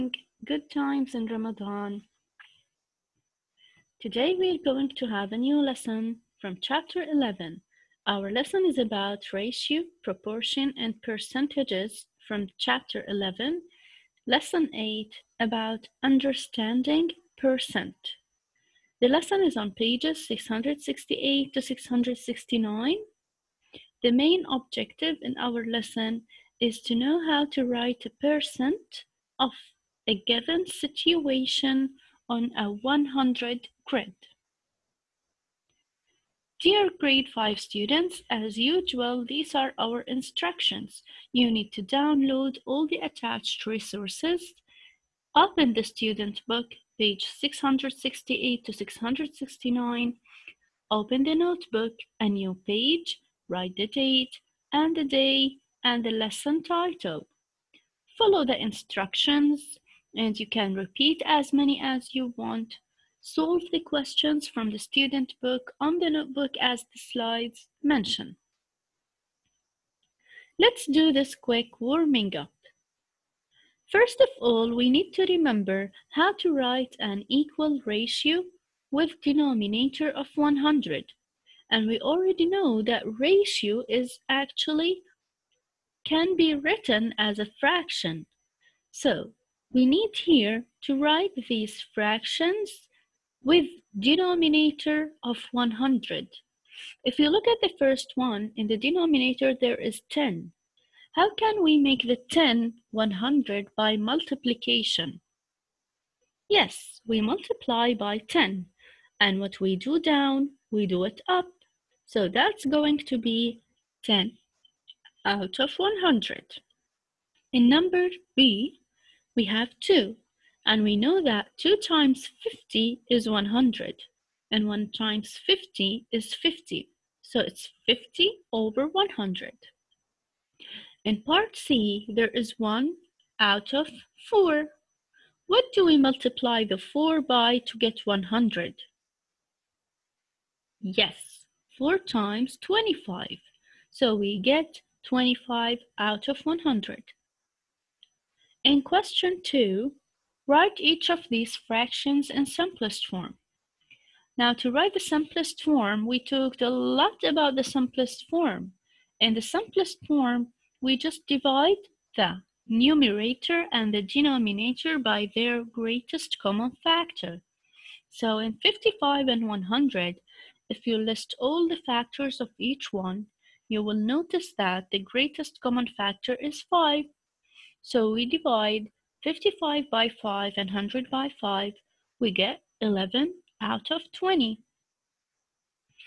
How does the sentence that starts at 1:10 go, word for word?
Let's do this quick warming up.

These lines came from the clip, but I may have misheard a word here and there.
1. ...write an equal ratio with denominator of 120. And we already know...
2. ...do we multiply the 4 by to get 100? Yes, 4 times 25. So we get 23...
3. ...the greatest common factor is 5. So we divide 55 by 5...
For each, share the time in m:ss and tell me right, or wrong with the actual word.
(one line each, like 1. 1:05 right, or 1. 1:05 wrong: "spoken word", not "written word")
1. 1:16 wrong: "100", not "120"
2. 2:15 wrong: "25", not "23"
3. 2:54 right.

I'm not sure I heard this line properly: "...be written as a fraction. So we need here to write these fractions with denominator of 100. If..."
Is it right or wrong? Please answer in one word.
right.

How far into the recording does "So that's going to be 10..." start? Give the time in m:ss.
1:52.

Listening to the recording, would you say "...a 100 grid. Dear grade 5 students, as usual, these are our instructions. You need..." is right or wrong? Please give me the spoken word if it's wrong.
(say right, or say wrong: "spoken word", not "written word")
right.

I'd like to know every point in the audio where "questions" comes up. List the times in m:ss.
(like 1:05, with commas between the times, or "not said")
1:03, 2:28.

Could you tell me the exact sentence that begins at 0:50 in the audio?
Open the notebook, a new page, Write the date and the day and the lesson title.